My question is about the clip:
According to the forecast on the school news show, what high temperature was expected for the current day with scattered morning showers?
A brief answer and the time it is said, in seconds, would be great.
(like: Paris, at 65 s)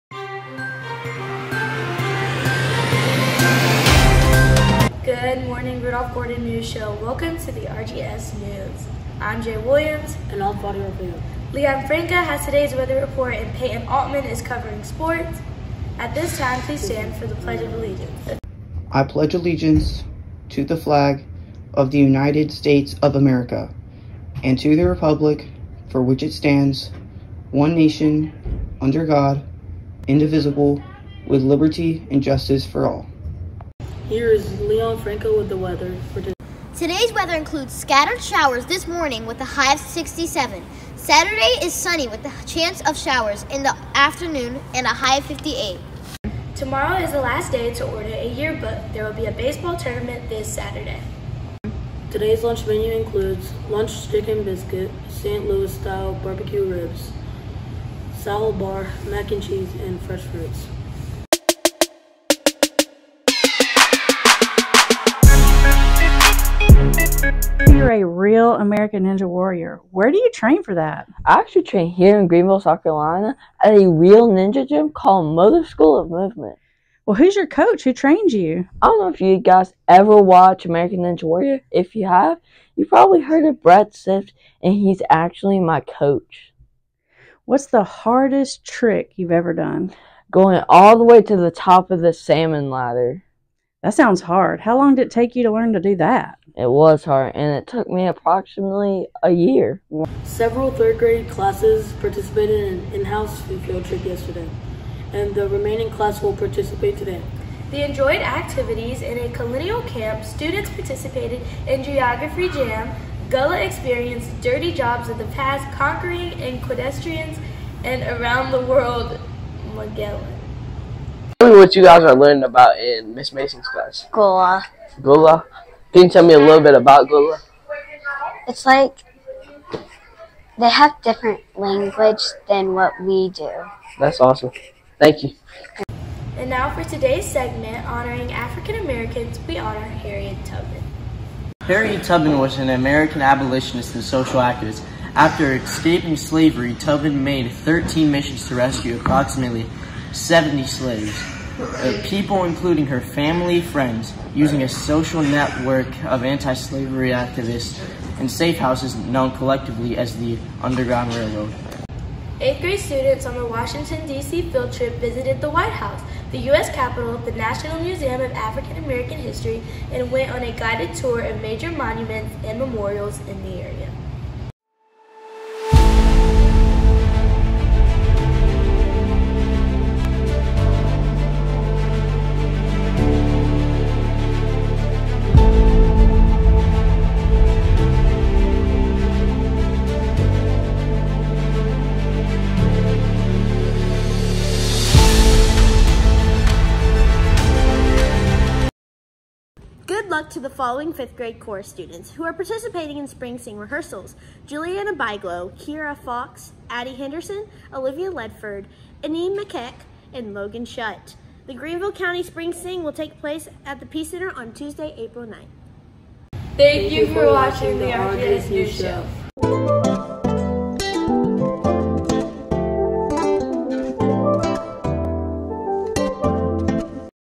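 67, at 39 s.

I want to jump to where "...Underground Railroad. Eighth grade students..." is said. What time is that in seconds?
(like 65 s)
160 s.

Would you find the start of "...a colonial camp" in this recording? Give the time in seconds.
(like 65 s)
109 s.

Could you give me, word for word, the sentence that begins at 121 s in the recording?
Tell me what you guys are learning about in Miss Mason's class.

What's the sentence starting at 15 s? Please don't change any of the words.
At this time, please stand for the Pledge of Allegiance.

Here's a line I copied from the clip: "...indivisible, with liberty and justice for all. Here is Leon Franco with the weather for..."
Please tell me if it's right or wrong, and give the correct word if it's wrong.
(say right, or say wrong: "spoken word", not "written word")
right.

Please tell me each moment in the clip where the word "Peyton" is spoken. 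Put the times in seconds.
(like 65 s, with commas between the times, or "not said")
13 s.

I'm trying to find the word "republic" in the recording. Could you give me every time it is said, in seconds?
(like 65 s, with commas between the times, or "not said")
24 s.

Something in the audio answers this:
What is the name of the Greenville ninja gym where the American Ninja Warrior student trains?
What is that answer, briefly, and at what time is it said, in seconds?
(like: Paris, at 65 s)
Mother School of Movement, at 75 s.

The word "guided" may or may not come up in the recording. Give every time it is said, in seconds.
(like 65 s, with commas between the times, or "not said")
170 s.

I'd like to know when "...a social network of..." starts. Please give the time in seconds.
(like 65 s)
154 s.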